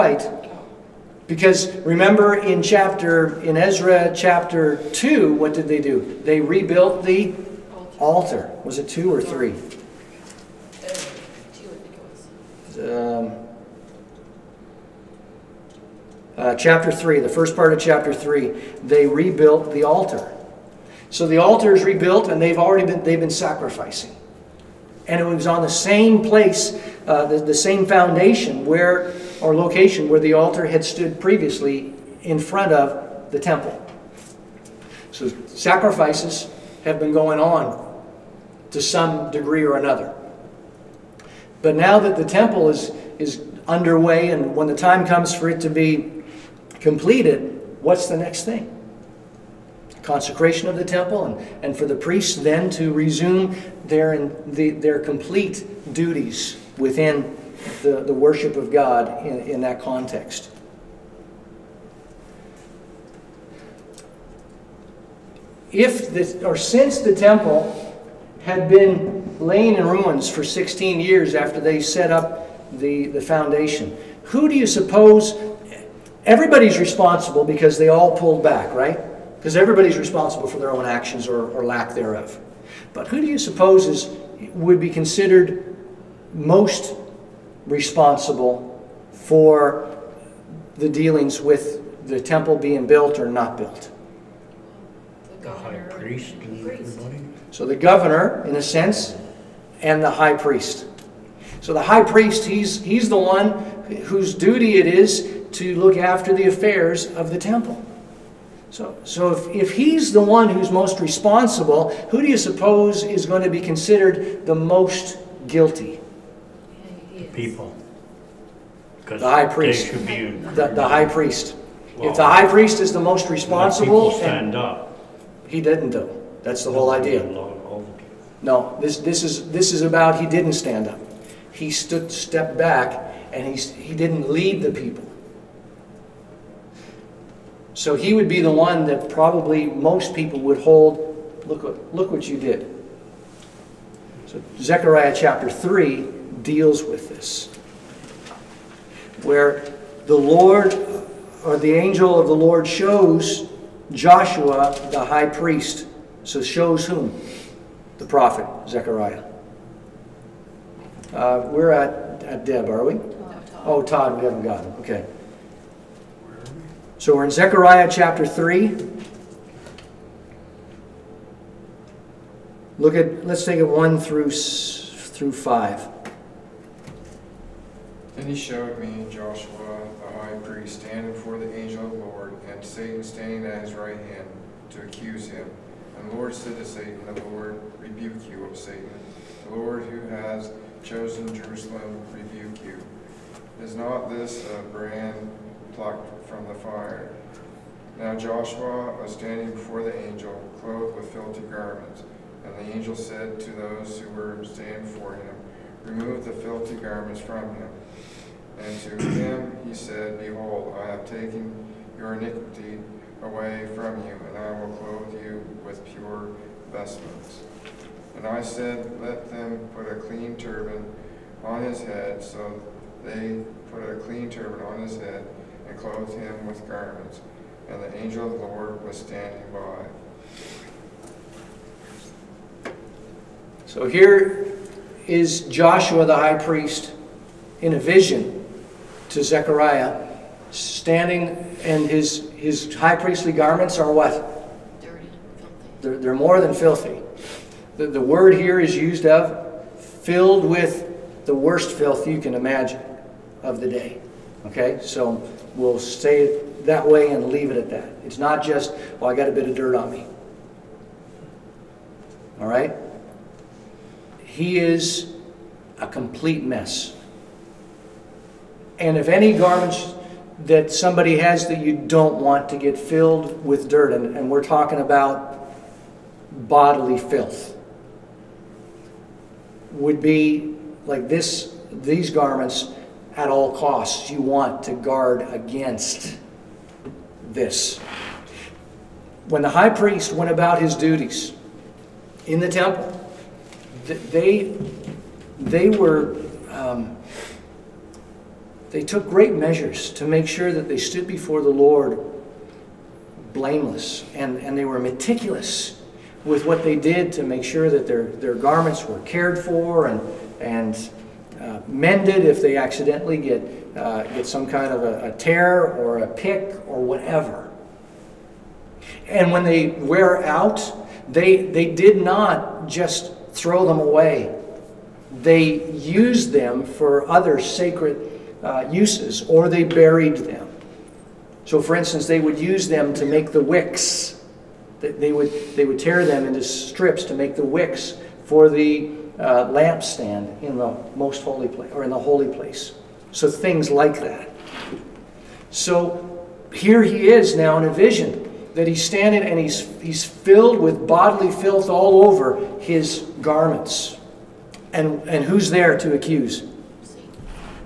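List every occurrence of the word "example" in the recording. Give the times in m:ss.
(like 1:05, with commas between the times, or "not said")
not said.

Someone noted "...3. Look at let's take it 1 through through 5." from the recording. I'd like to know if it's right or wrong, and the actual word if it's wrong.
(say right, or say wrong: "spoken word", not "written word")
right.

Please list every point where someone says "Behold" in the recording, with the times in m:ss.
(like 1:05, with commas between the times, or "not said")
3:30.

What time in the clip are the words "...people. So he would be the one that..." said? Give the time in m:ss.
2:14.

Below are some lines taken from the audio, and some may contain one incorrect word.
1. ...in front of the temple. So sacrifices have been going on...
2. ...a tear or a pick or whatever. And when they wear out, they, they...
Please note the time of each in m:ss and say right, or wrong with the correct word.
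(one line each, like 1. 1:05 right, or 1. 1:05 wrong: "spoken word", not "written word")
1. 0:32 right
2. 5:15 right.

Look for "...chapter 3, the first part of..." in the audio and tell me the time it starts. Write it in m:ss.
0:16.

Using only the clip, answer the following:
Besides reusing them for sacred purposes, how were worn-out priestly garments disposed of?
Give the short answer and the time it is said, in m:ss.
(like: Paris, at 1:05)
buried them, at 5:29.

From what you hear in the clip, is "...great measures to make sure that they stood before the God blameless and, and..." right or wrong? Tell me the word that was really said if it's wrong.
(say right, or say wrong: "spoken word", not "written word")
wrong: "Lord", not "God".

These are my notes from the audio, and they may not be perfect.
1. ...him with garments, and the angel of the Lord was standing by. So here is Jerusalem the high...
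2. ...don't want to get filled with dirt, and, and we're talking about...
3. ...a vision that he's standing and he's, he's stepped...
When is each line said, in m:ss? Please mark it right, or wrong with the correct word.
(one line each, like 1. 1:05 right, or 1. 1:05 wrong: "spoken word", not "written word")
1. 3:46 wrong: "Joshua", not "Jerusalem"
2. 4:31 right
3. 5:47 wrong: "filled", not "stepped".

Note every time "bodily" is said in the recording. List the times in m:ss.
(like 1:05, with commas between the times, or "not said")
4:36, 5:50.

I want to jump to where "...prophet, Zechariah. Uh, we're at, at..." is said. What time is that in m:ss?
2:38.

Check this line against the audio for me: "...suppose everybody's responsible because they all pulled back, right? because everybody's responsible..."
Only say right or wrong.
right.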